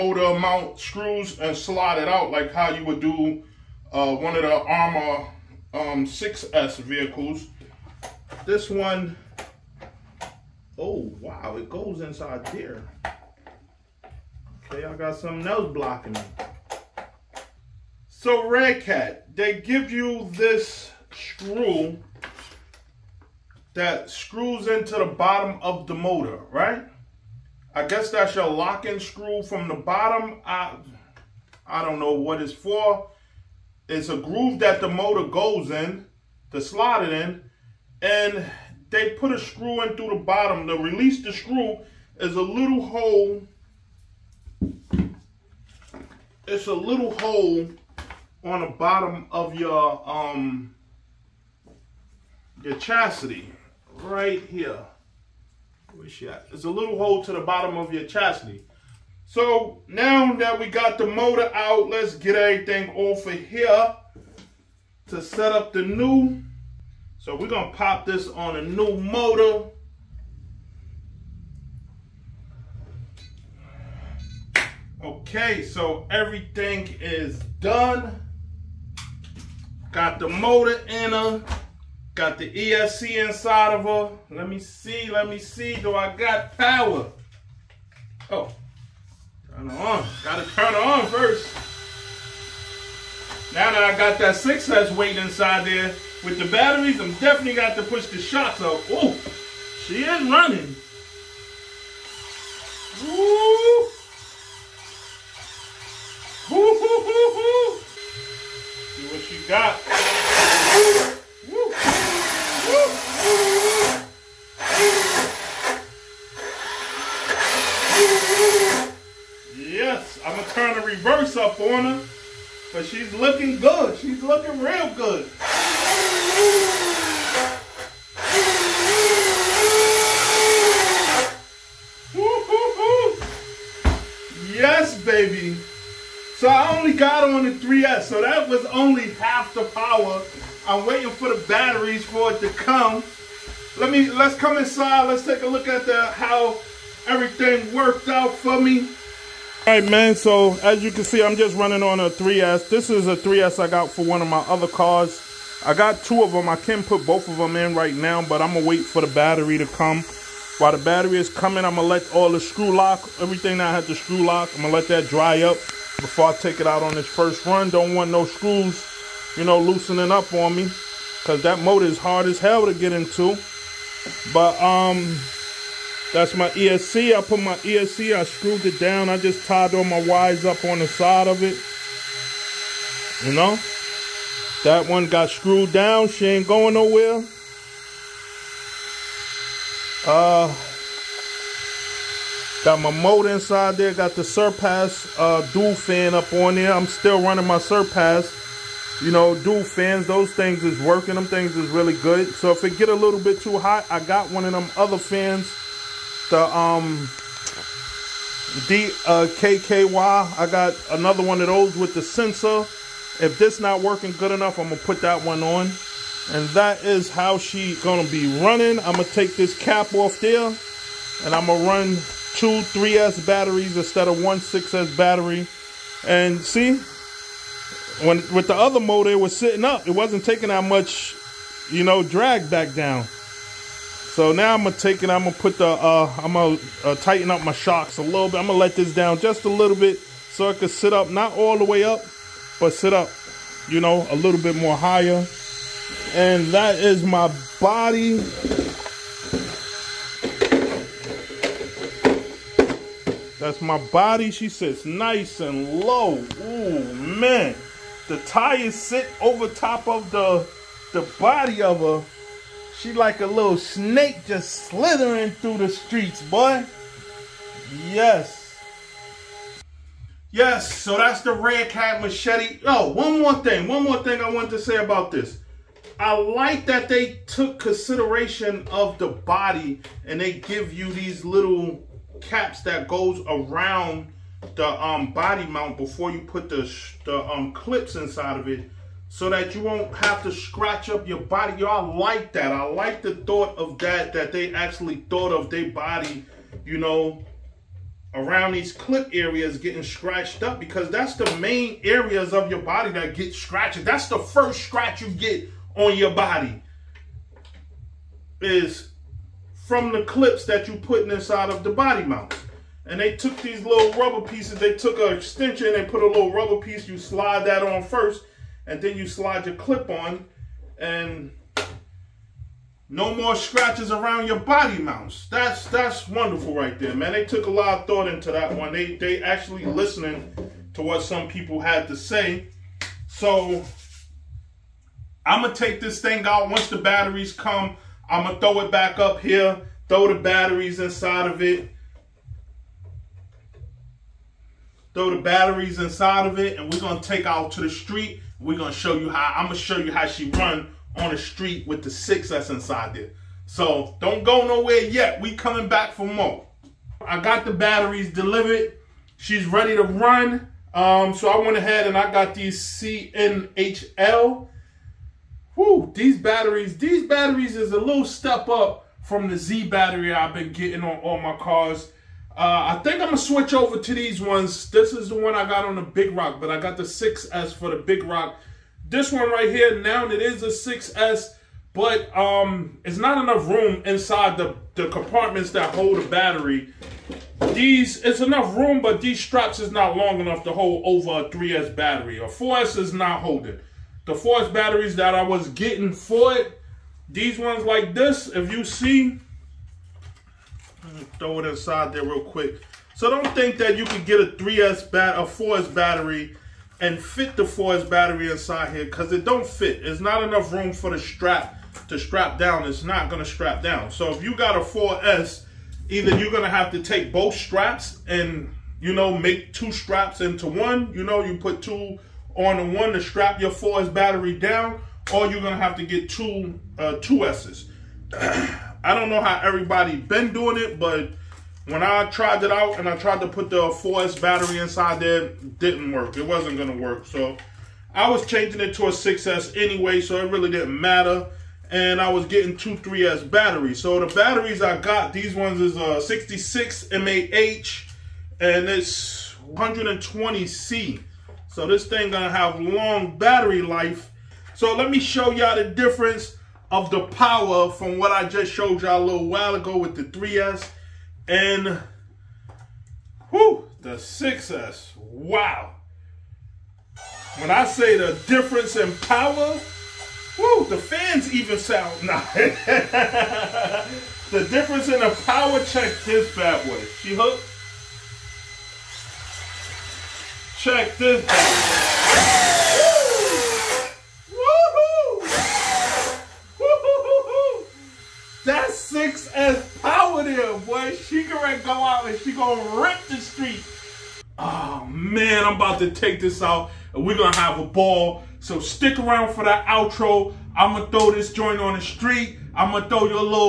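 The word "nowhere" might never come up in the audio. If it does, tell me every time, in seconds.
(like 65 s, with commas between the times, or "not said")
186 s, 354 s.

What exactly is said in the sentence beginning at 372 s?
Uh, I think I'm gonna switch over to these ones.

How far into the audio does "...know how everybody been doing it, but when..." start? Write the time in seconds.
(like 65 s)
429 s.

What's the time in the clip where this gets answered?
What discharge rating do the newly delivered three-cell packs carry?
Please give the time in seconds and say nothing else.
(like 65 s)
449 s.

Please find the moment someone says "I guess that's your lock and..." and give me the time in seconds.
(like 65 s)
27 s.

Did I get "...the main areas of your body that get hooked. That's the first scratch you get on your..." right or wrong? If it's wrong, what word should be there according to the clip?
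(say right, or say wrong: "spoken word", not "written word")
wrong: "scratched", not "hooked".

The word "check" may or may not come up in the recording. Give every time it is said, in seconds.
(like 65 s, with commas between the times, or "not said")
475 s, 480 s.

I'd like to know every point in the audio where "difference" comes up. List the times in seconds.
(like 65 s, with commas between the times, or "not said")
455 s, 468 s, 474 s.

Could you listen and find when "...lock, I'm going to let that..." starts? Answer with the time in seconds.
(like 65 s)
164 s.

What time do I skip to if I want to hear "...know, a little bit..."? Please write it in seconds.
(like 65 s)
243 s.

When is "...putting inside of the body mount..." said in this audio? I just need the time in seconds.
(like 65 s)
310 s.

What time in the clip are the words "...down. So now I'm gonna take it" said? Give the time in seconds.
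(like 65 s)
232 s.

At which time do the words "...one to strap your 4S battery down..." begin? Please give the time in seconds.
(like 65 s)
422 s.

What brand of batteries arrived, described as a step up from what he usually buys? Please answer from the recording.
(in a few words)
CNHL.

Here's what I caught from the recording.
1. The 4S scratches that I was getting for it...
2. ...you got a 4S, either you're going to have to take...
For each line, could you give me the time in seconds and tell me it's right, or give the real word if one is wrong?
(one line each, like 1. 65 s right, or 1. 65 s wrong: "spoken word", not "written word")
1. 394 s wrong: "batteries", not "scratches"
2. 414 s right.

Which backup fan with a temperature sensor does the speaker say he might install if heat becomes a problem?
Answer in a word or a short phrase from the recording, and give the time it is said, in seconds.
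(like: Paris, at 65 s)
KKY, at 209 s.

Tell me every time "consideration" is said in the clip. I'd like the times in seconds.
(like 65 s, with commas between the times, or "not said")
277 s.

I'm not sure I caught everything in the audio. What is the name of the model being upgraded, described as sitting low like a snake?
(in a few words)
Redcat Machete.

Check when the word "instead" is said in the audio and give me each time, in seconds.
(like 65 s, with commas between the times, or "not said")
223 s.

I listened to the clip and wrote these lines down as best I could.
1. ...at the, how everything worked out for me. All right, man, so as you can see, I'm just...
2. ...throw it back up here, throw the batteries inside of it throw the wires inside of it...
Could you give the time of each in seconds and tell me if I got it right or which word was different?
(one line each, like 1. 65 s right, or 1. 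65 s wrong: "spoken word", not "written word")
1. 145 s right
2. 338 s wrong: "batteries", not "wires".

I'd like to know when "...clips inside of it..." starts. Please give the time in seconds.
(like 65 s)
287 s.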